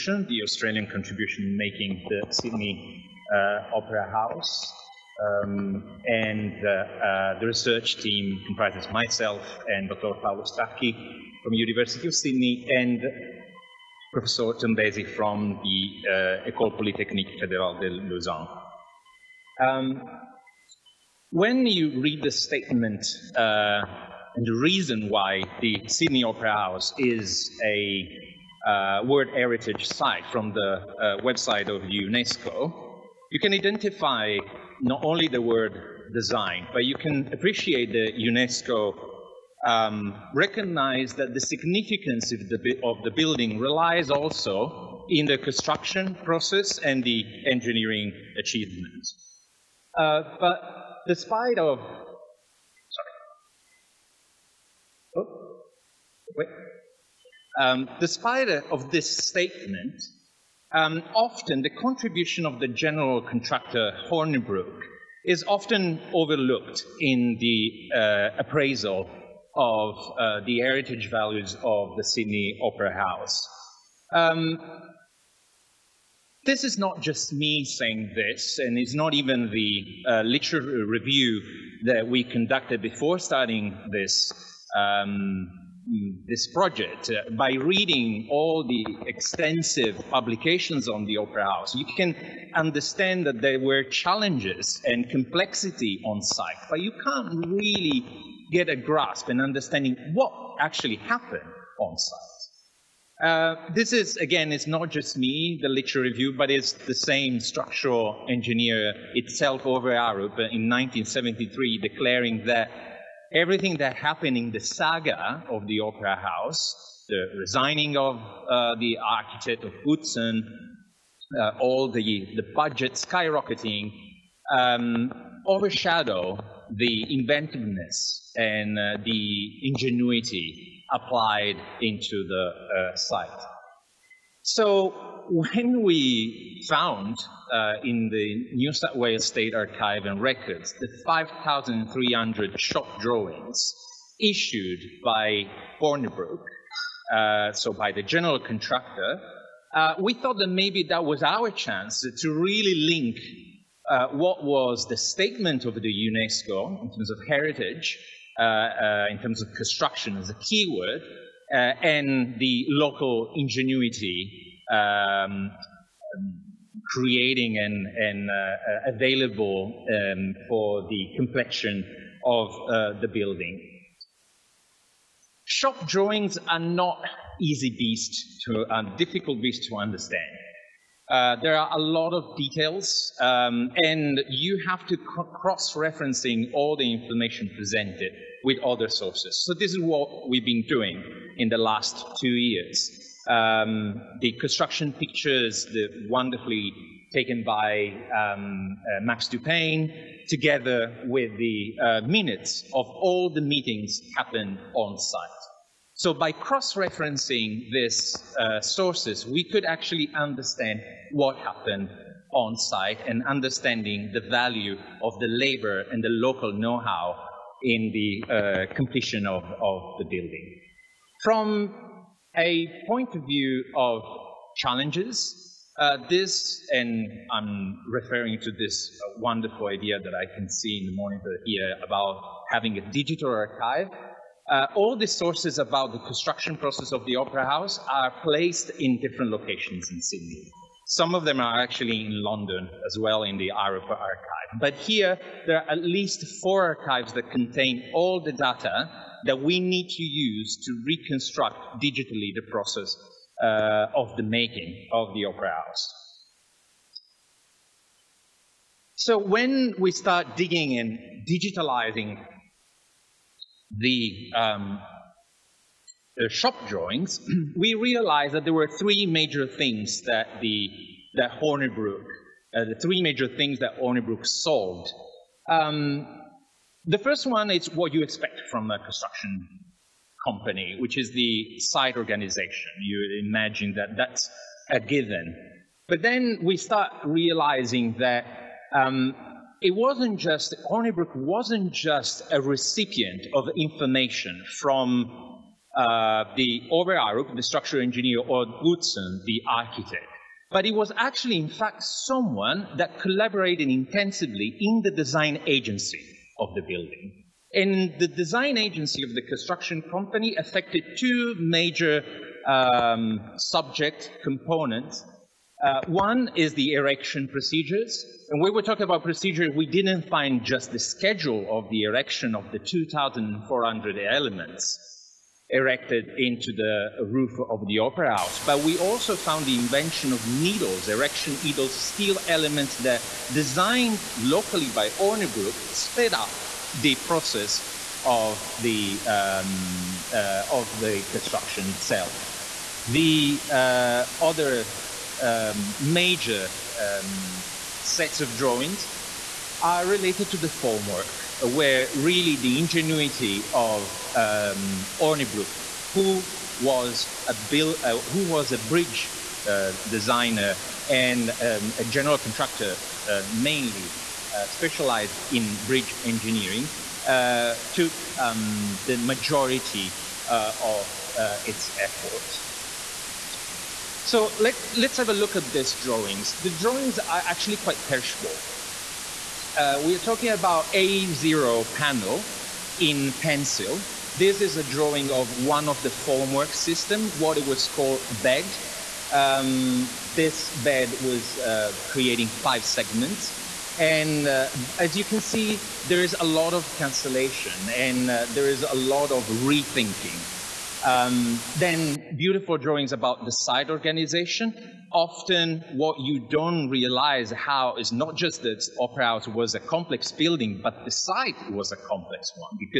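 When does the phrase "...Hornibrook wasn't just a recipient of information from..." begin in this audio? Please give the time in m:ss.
4:50.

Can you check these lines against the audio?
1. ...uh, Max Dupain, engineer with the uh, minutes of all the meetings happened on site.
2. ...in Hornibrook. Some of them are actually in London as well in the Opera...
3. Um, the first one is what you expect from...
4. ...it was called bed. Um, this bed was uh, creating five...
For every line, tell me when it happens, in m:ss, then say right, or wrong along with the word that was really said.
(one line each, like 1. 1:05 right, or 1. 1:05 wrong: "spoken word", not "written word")
1. 3:18 wrong: "together", not "engineer"
2. 3:59 wrong: "Sydney", not "Hornibrook"
3. 4:35 right
4. 6:27 right.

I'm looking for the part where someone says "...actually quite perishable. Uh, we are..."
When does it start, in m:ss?
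6:17.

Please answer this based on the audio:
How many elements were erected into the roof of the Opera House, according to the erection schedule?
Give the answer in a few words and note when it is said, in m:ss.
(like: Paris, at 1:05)
2,400, at 5:22.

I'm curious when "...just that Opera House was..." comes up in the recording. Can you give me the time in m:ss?
6:48.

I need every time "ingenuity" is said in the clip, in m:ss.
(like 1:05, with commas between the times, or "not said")
2:09, 2:43, 5:52.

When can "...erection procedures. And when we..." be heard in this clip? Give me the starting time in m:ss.
5:16.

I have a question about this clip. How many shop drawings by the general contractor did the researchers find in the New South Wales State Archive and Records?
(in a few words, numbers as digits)
5,300.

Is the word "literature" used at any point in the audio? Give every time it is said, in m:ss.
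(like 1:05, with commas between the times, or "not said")
1:20, 1:45.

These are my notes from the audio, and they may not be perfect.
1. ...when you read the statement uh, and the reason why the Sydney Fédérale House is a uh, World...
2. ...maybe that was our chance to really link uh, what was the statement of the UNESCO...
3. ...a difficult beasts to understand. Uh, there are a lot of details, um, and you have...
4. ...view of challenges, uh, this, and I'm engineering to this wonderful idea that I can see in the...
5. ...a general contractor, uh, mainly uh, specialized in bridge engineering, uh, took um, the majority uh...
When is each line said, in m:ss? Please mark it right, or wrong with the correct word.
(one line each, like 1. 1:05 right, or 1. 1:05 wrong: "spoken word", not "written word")
1. 0:21 wrong: "Opera", not "Fédérale"
2. 2:30 right
3. 2:58 right
4. 3:43 wrong: "referring", not "engineering"
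5. 6:01 right.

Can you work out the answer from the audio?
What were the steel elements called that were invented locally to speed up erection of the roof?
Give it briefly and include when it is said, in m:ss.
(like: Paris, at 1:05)
erection needles, at 5:30.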